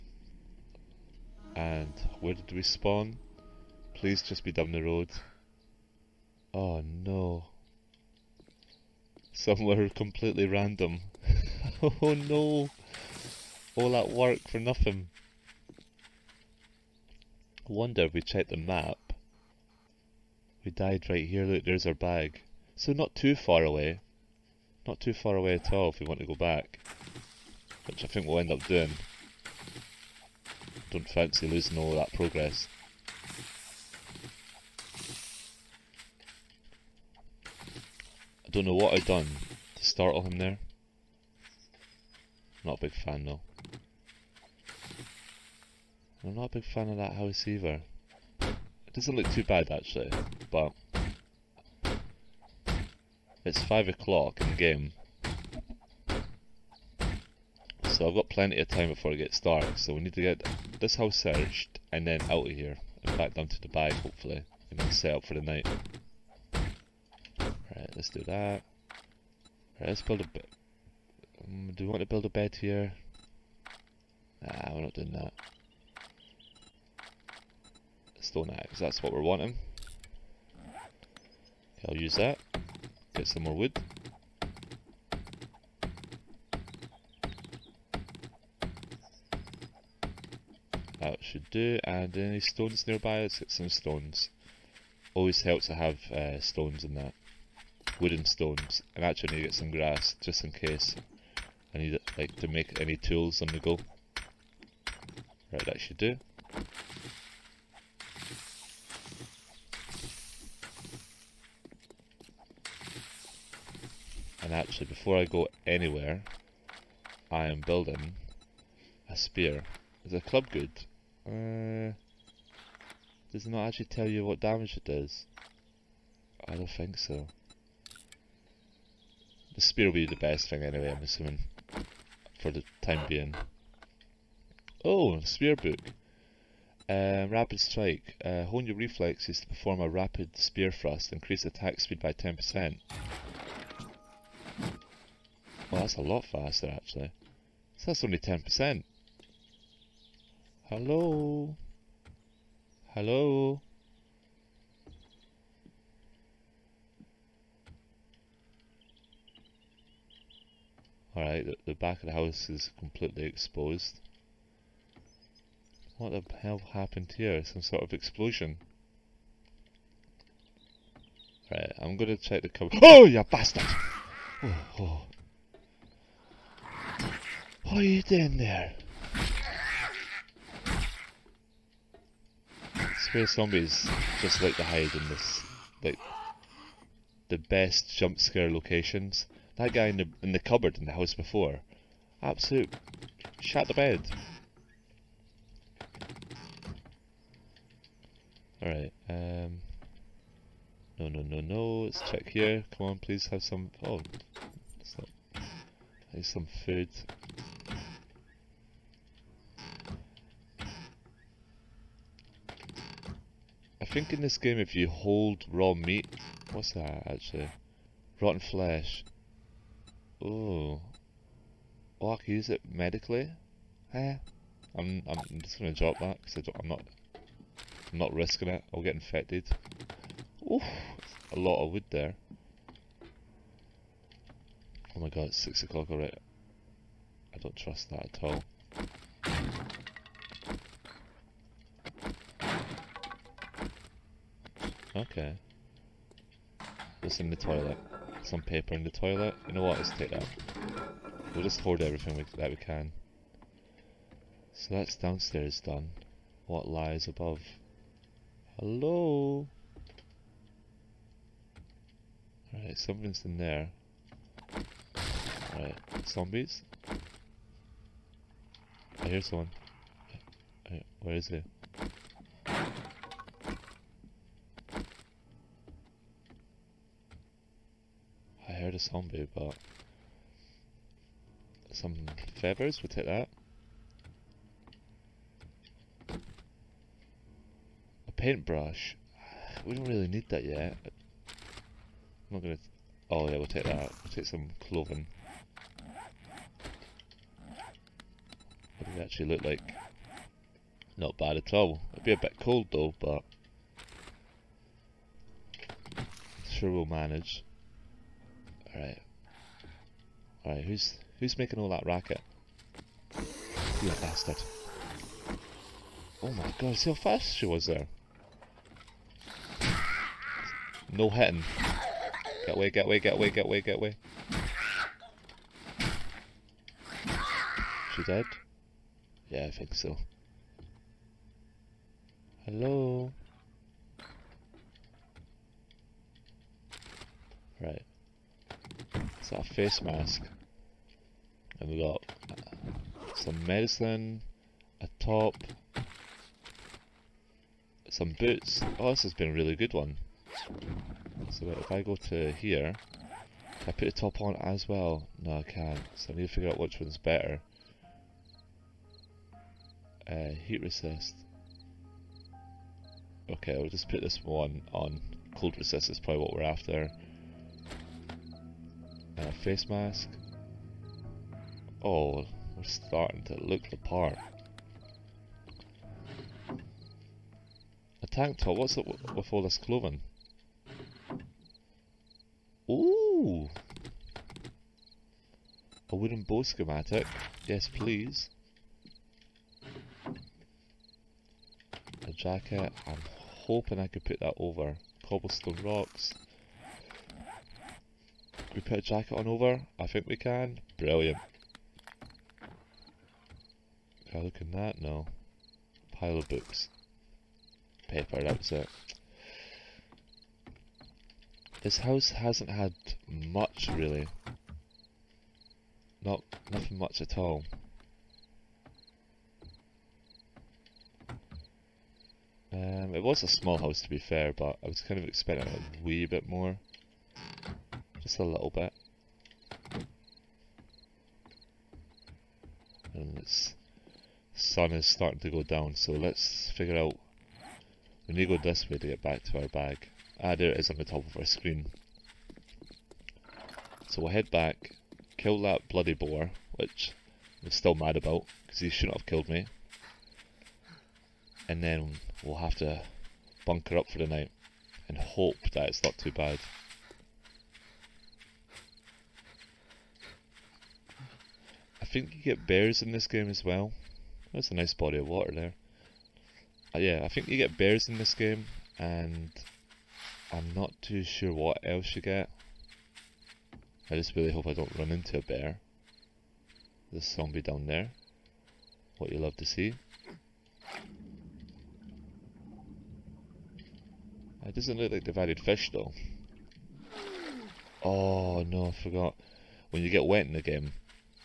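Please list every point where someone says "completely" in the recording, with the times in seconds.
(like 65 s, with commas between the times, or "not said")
9 s, 162 s.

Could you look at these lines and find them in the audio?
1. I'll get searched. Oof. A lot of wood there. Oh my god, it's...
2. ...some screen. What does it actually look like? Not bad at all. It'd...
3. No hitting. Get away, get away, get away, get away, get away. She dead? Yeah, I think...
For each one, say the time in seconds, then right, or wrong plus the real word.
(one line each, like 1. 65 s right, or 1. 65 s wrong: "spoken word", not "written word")
1. 228 s wrong: "infected", not "searched"
2. 294 s wrong: "cloven", not "screen"
3. 320 s right.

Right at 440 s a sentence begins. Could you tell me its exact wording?
Ah, there it is on the top of our screen.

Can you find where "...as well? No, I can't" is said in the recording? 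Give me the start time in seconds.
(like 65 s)
354 s.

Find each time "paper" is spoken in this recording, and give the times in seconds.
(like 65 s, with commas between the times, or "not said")
248 s, 407 s.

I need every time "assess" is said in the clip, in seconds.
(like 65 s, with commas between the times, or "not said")
not said.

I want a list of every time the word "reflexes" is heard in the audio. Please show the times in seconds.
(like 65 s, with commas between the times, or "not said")
138 s.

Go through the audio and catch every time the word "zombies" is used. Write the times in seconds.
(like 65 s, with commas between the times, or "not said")
183 s, 266 s, 278 s, 477 s.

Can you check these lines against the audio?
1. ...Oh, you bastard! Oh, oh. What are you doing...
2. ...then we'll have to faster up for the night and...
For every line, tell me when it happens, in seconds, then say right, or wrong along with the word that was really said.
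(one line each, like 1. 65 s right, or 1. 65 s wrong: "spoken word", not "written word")
1. 172 s right
2. 451 s wrong: "bunker", not "faster".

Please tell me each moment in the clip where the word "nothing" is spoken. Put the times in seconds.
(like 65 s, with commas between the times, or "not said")
14 s, 416 s.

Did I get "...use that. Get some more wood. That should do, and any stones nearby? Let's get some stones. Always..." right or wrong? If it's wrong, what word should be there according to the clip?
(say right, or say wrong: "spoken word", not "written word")
right.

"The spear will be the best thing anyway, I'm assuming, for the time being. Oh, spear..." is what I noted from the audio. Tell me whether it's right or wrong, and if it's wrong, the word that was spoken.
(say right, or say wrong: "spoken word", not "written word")
right.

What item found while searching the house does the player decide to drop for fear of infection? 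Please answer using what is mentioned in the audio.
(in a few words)
Rotten flesh.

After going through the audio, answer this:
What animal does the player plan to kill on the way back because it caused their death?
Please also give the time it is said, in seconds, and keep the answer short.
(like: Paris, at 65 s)
Boar, at 445 s.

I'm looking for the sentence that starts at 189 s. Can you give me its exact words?
That guy in the, in the cupboard in the house before, absolute shat the bed.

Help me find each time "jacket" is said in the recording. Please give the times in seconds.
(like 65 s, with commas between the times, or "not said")
392 s, 398 s.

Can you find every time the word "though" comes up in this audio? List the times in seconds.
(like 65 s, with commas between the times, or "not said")
43 s, 302 s, 485 s.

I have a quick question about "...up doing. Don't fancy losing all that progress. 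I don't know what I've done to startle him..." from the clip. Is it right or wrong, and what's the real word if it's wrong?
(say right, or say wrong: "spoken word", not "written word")
right.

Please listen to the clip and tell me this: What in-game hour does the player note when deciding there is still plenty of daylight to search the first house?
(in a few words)
5 o'clock.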